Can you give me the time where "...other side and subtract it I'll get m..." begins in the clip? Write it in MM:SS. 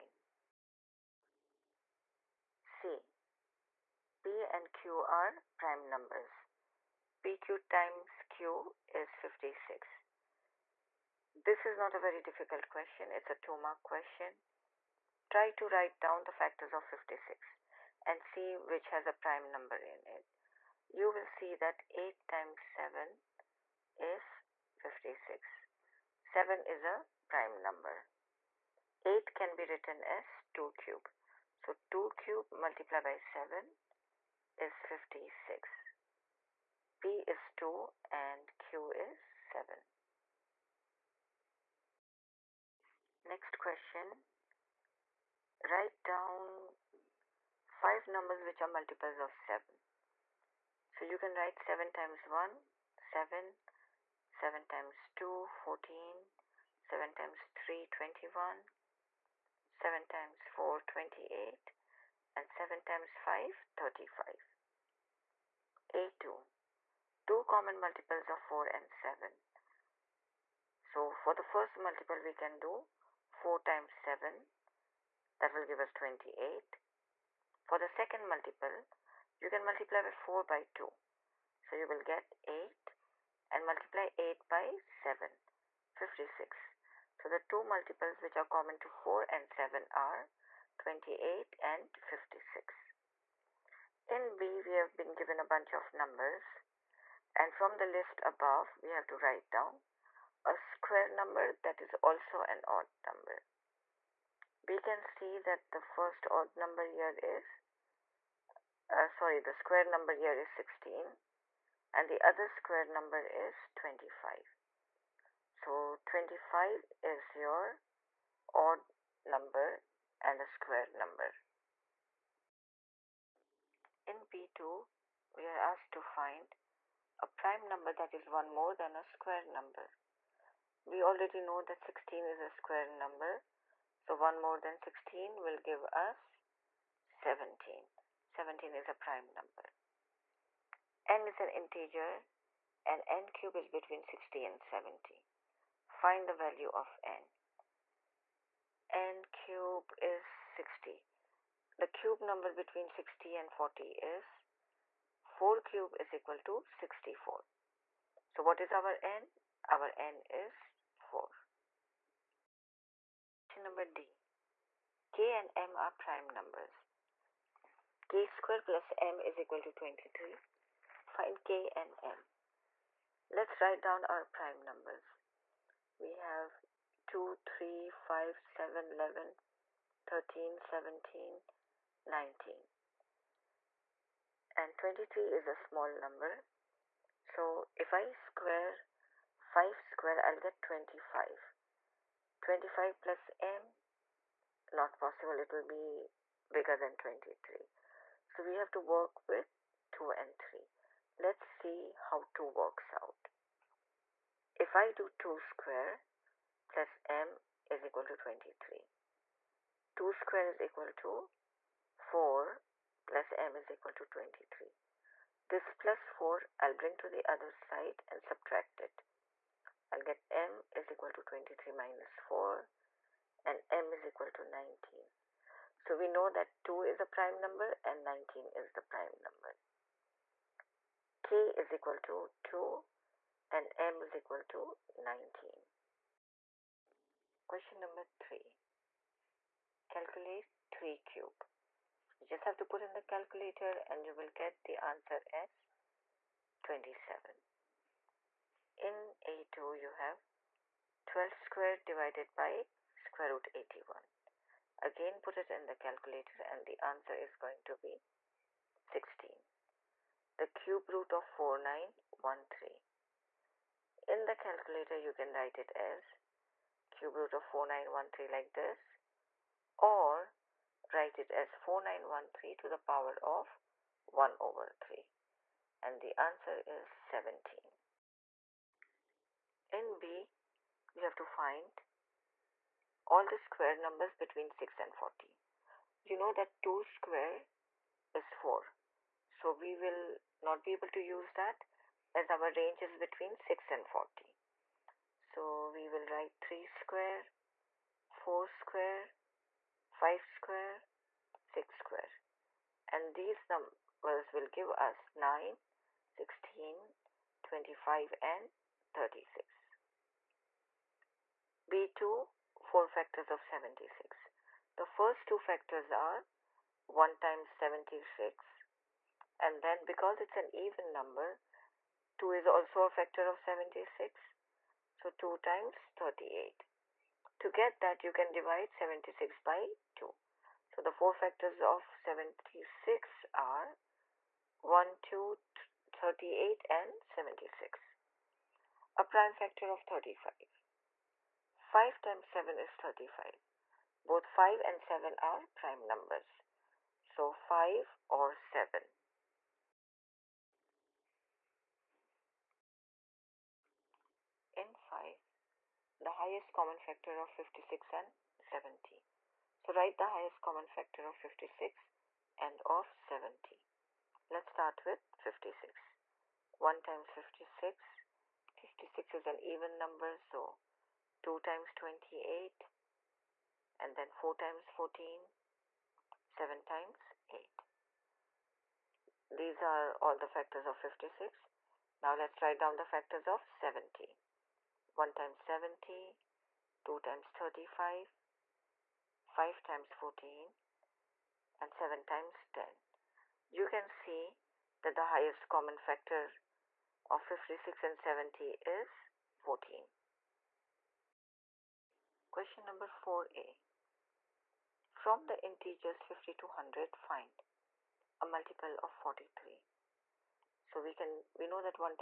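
03:37.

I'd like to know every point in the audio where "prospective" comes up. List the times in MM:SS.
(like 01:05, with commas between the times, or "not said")
not said.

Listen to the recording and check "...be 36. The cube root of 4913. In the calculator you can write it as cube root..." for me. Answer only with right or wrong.
wrong.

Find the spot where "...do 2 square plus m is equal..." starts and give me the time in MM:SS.
03:24.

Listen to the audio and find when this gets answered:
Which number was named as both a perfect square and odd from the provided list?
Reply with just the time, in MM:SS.
01:56.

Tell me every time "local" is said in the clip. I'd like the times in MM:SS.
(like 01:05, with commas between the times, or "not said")
not said.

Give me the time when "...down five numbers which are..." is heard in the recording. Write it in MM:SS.
00:46.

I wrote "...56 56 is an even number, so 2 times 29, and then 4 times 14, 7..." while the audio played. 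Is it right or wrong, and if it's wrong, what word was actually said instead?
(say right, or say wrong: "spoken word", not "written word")
wrong: "28", not "29".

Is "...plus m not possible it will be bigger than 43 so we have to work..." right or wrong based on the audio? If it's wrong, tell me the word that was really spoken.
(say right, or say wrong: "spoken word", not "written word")
wrong: "23", not "43".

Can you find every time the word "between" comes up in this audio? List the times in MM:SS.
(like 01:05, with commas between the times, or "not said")
02:23, 02:32, 04:44, 04:52.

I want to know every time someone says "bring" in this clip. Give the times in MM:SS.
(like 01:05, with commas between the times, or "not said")
03:36.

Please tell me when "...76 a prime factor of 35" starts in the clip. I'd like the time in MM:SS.
05:37.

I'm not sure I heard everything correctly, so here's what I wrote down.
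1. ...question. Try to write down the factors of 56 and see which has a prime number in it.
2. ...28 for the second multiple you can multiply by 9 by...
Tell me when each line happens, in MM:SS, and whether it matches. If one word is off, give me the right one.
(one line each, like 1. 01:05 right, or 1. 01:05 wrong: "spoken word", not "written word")
1. 00:13 right
2. 01:15 wrong: "4", not "9".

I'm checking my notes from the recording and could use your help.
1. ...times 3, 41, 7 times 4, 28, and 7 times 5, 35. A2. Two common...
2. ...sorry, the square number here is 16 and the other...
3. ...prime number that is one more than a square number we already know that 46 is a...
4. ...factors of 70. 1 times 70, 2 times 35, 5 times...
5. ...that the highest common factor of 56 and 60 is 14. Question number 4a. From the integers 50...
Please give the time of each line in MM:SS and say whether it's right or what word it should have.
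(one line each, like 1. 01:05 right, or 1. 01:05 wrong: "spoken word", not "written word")
1. 00:57 wrong: "21", not "41"
2. 01:49 right
3. 02:07 wrong: "16", not "46"
4. 06:22 right
5. 06:34 wrong: "70", not "60".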